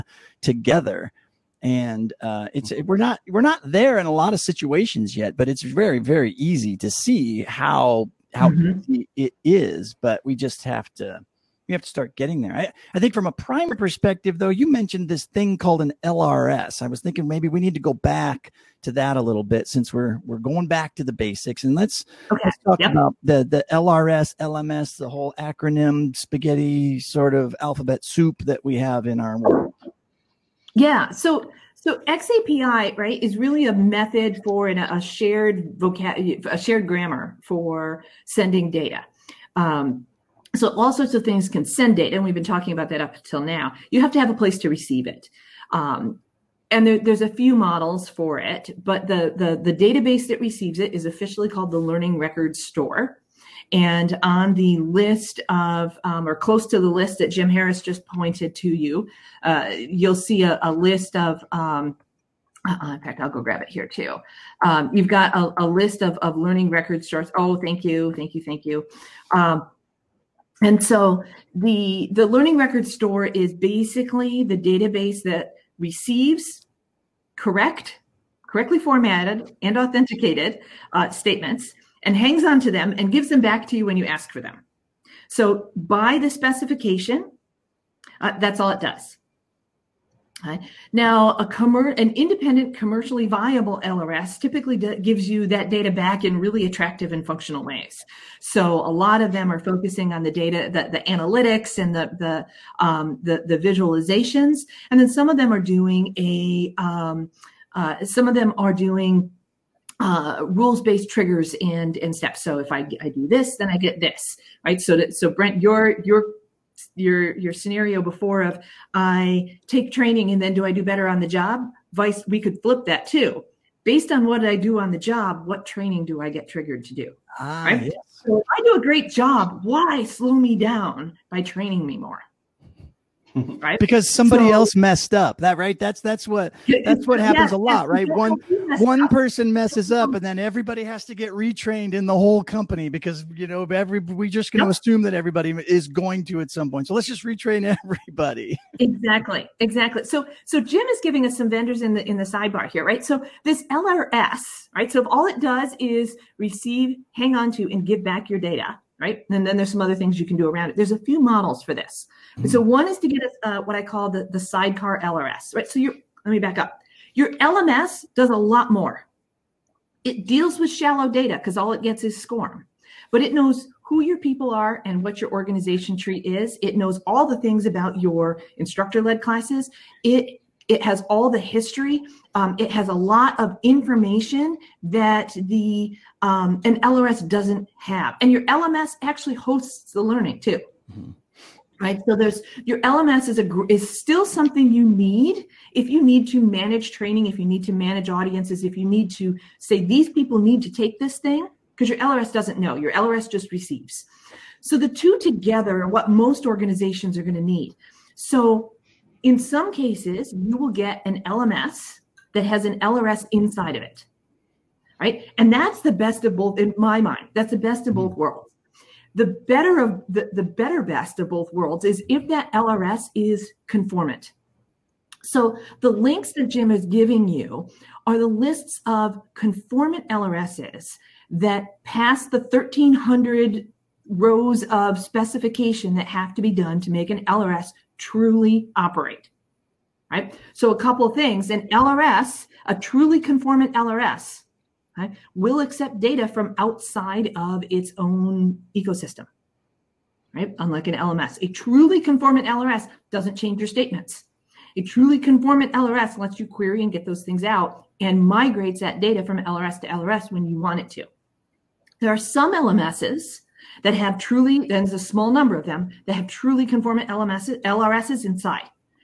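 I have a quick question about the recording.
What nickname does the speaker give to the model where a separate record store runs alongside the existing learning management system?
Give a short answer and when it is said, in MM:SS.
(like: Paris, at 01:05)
sidecar LRS, at 02:44.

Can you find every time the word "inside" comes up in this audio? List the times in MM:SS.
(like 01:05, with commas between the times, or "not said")
03:33, 04:28.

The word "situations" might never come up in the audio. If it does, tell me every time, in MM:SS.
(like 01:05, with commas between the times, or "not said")
00:04.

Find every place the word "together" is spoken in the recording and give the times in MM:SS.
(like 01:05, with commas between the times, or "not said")
00:00, 03:25.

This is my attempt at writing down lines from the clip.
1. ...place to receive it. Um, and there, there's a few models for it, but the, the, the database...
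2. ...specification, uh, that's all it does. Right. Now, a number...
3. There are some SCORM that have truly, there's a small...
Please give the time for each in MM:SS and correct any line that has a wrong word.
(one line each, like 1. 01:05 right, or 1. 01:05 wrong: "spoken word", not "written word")
1. 00:44 right
2. 01:26 wrong: "commer", not "number"
3. 04:21 wrong: "LMSs", not "SCORM".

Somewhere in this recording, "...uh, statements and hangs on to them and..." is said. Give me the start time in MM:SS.
01:20.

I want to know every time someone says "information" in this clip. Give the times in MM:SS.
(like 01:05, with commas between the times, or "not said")
03:03.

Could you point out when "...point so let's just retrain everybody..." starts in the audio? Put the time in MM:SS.
02:26.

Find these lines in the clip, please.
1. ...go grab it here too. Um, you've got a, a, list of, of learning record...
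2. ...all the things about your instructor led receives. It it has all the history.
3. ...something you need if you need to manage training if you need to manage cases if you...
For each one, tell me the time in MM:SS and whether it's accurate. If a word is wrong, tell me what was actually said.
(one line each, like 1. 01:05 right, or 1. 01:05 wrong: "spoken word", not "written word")
1. 01:03 right
2. 02:57 wrong: "classes", not "receives"
3. 03:14 wrong: "audiences", not "cases".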